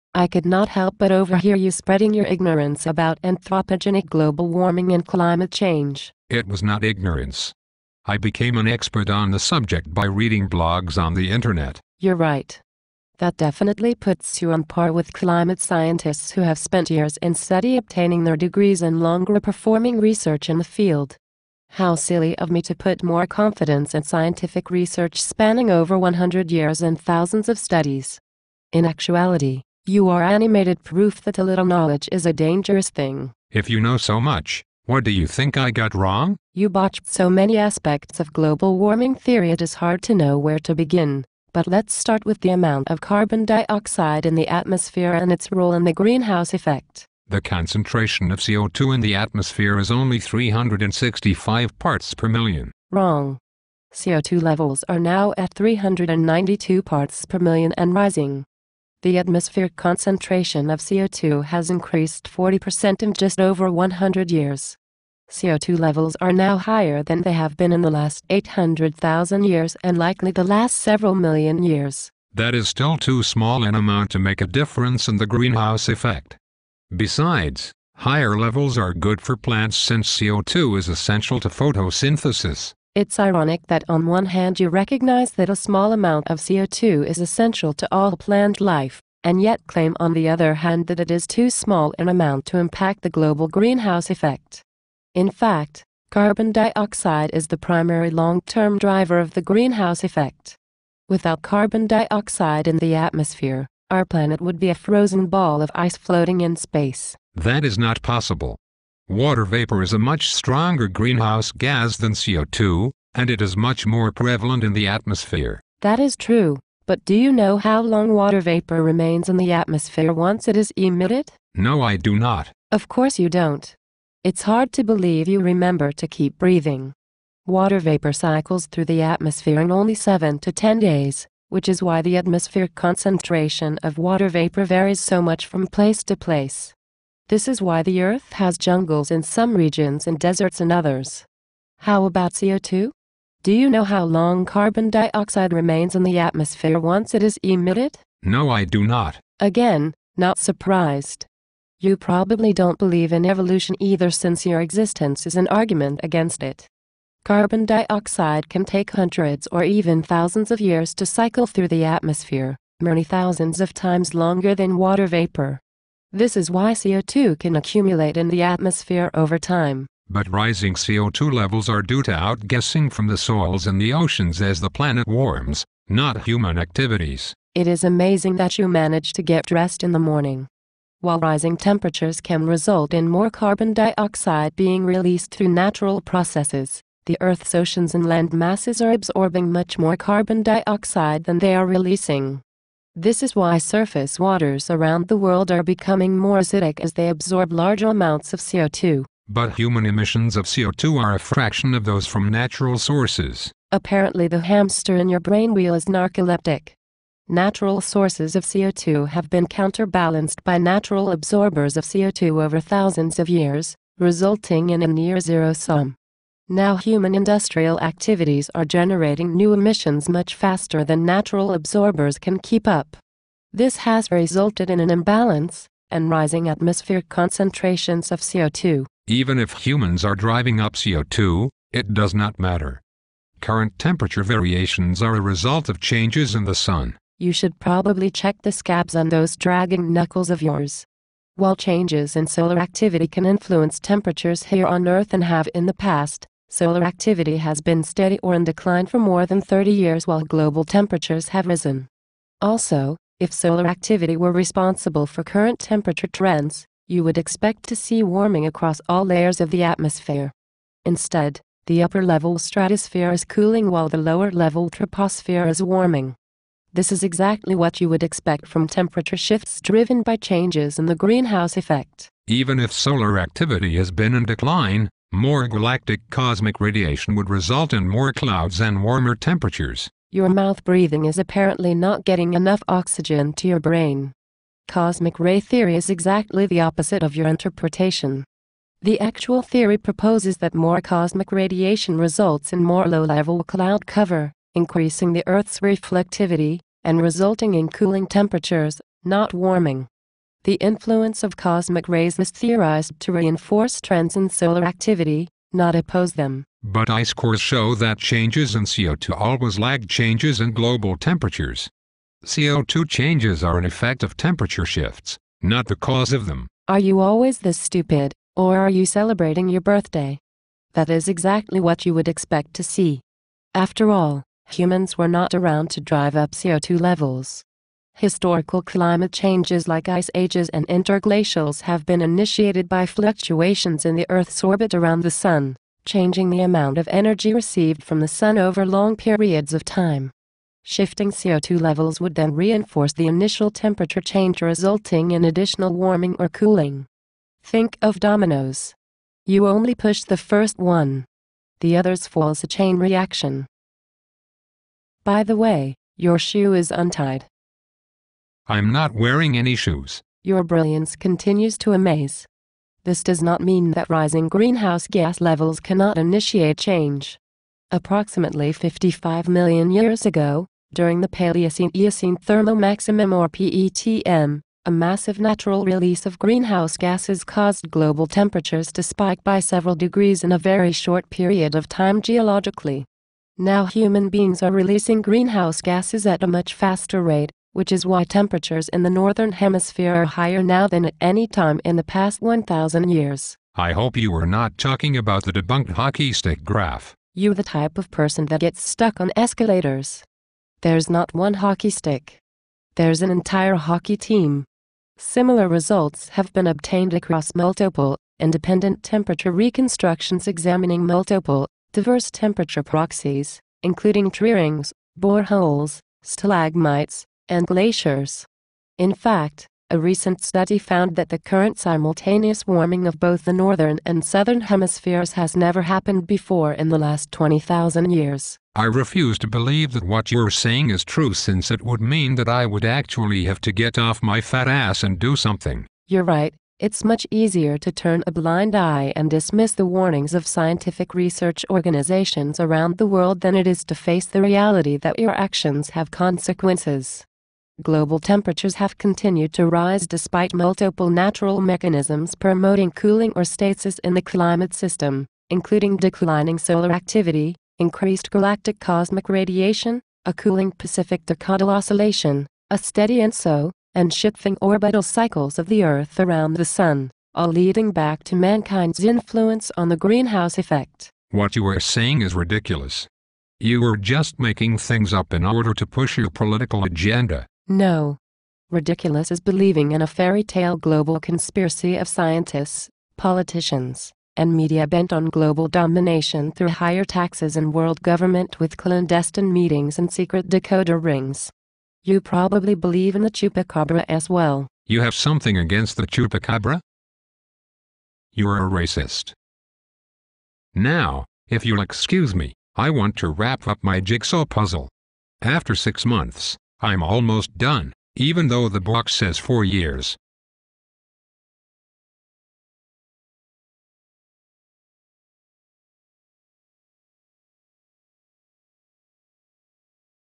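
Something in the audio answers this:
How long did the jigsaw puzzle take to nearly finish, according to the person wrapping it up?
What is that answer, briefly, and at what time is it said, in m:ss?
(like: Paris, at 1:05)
6 months, at 8:25.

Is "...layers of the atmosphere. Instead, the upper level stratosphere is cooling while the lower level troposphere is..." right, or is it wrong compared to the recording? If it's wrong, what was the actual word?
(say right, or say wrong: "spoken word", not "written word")
right.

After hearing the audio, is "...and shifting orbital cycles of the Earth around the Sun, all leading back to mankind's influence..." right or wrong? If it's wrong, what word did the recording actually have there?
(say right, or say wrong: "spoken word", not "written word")
right.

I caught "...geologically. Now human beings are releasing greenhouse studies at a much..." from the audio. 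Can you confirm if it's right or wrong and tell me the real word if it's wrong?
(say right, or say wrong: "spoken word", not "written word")
wrong: "gases", not "studies".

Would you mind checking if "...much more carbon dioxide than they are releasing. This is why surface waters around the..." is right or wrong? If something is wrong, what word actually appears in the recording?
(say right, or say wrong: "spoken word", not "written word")
right.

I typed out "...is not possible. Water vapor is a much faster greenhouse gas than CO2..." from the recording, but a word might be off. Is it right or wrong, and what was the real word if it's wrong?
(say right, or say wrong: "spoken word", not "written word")
wrong: "stronger", not "faster".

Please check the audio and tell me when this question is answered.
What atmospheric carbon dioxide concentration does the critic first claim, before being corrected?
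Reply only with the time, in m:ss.
0:50.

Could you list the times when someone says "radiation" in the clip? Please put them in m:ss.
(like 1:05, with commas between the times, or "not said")
4:36, 4:51, 7:39.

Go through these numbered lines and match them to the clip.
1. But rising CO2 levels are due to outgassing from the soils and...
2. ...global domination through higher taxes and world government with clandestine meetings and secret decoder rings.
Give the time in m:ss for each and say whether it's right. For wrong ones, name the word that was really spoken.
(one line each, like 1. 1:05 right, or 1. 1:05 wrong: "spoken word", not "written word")
1. 2:50 right
2. 8:05 right.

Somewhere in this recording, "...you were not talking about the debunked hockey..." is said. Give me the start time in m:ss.
6:33.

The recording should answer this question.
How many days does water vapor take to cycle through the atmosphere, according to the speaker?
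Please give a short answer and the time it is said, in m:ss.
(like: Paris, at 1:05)
7 to 10 days, at 2:09.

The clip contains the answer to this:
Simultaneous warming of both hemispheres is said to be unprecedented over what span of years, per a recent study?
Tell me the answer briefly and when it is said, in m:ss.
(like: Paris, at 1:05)
20,000 years, at 7:07.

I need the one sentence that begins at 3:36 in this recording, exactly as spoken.
Now human industrial activities are generating new emissions much faster than natural absorbers can keep up.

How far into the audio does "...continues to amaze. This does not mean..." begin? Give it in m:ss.
6:00.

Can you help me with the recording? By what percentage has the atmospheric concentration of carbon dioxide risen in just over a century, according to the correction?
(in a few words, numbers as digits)
40%.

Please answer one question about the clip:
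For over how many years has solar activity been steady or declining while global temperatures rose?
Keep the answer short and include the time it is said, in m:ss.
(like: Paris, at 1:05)
30 years, at 4:09.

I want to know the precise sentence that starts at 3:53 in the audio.
Current temperature variations are a result of changes in the sun.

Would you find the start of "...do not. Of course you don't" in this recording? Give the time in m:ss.
2:01.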